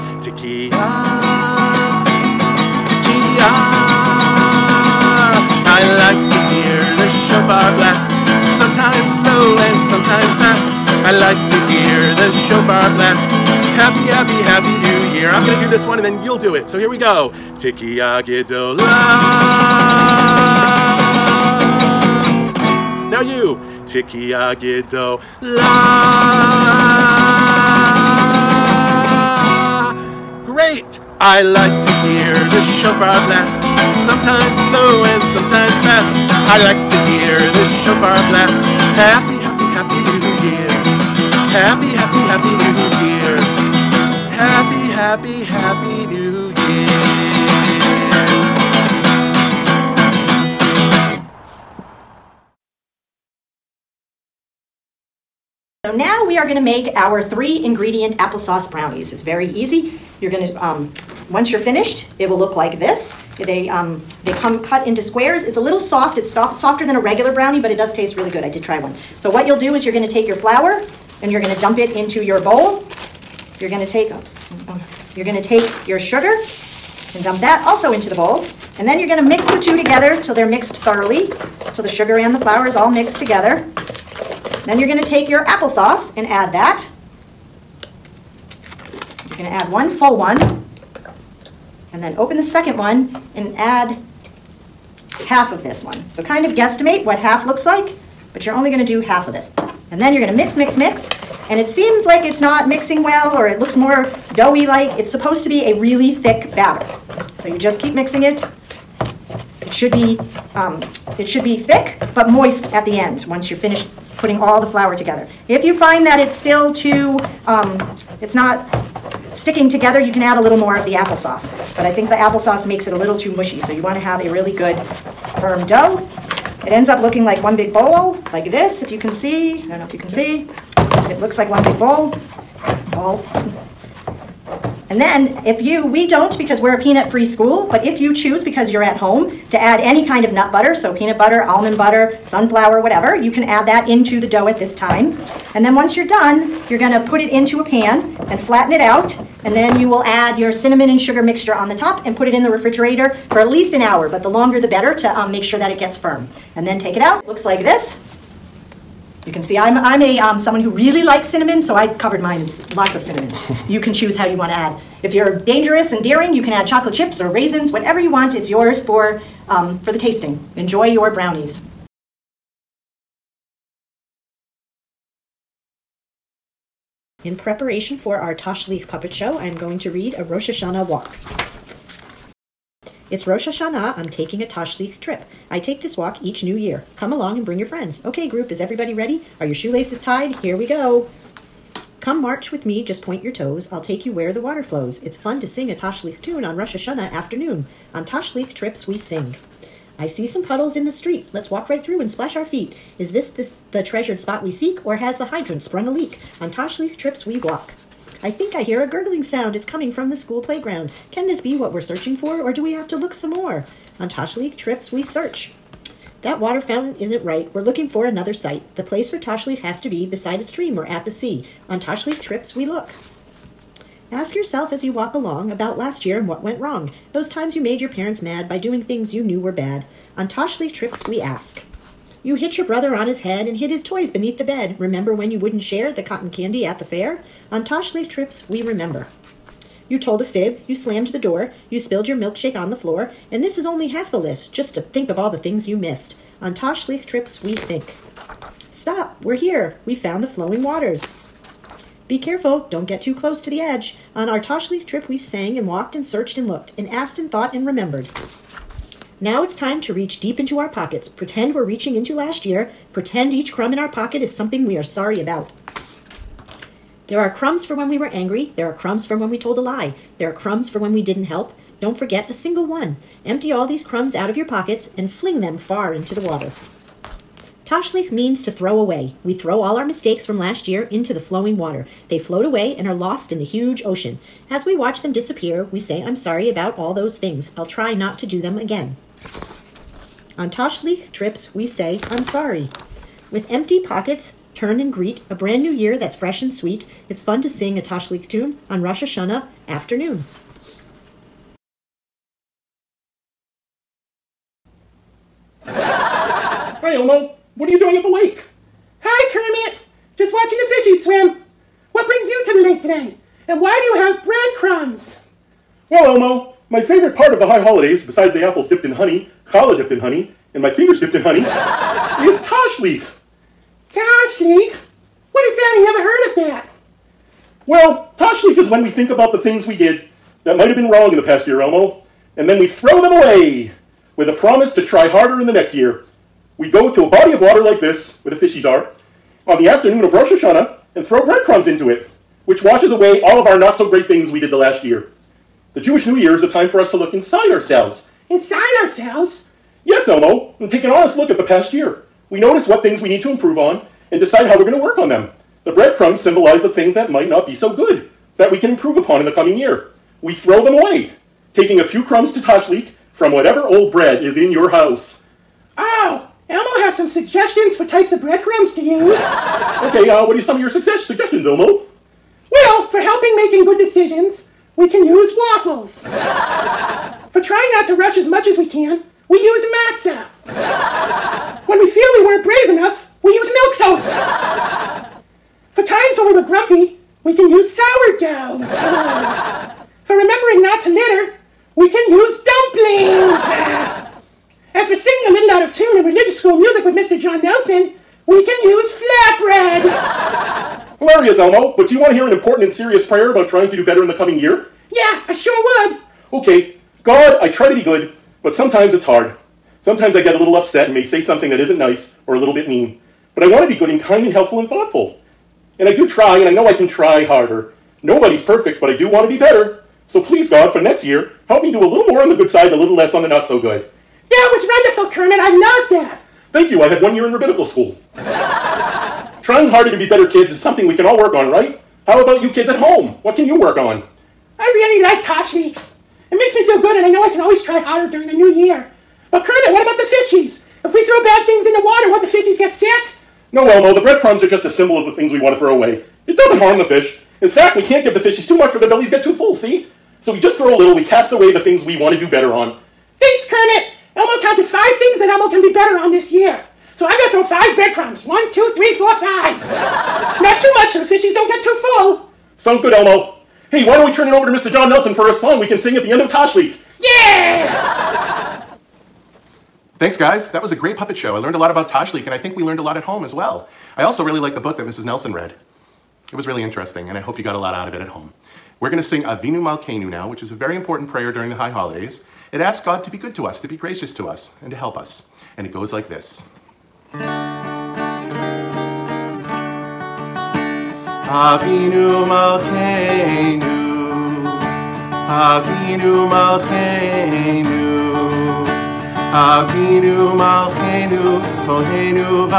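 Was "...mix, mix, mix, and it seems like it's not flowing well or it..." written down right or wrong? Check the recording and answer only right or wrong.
wrong.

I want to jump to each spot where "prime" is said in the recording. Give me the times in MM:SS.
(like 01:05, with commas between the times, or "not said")
not said.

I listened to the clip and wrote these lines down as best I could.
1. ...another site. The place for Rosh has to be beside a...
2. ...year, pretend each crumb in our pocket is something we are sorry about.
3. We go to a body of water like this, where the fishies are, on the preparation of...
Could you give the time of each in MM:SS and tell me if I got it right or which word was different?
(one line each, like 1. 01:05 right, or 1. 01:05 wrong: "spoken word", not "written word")
1. 03:38 wrong: "Tashlich", not "Rosh"
2. 04:22 right
3. 05:36 wrong: "afternoon", not "preparation".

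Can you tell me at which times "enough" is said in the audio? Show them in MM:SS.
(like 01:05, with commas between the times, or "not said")
06:22.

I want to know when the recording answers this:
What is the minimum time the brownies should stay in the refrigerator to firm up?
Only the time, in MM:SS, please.
02:33.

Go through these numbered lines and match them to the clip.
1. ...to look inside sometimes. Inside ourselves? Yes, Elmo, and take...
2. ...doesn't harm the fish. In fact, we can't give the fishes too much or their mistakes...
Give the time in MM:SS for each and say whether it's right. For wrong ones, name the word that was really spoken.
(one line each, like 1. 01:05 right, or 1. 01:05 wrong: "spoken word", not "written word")
1. 05:46 wrong: "ourselves", not "sometimes"
2. 07:26 wrong: "bellies", not "mistakes".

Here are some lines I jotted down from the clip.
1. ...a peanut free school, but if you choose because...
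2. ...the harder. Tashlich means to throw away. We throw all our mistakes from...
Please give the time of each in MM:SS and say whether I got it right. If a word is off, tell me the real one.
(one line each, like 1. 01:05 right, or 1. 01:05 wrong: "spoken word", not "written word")
1. 02:16 right
2. 04:36 wrong: "water", not "harder".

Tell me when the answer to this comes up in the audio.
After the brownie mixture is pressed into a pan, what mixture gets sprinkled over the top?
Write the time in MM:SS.
02:30.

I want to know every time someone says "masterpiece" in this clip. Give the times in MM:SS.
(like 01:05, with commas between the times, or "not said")
not said.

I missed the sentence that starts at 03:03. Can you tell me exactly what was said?
It's Rosh Hashanah, I'm taking a Tashlich trip.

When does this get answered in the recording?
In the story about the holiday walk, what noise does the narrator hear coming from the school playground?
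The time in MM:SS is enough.
03:28.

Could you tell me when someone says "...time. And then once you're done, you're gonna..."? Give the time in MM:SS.
02:24.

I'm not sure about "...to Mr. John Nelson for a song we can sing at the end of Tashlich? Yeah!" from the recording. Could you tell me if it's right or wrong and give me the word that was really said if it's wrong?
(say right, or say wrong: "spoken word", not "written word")
right.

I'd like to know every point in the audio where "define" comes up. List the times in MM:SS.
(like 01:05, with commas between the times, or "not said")
not said.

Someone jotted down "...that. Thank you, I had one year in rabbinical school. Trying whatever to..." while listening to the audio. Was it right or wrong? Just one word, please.
wrong.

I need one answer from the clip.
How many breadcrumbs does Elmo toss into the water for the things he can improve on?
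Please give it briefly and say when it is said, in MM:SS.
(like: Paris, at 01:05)
5, at 07:37.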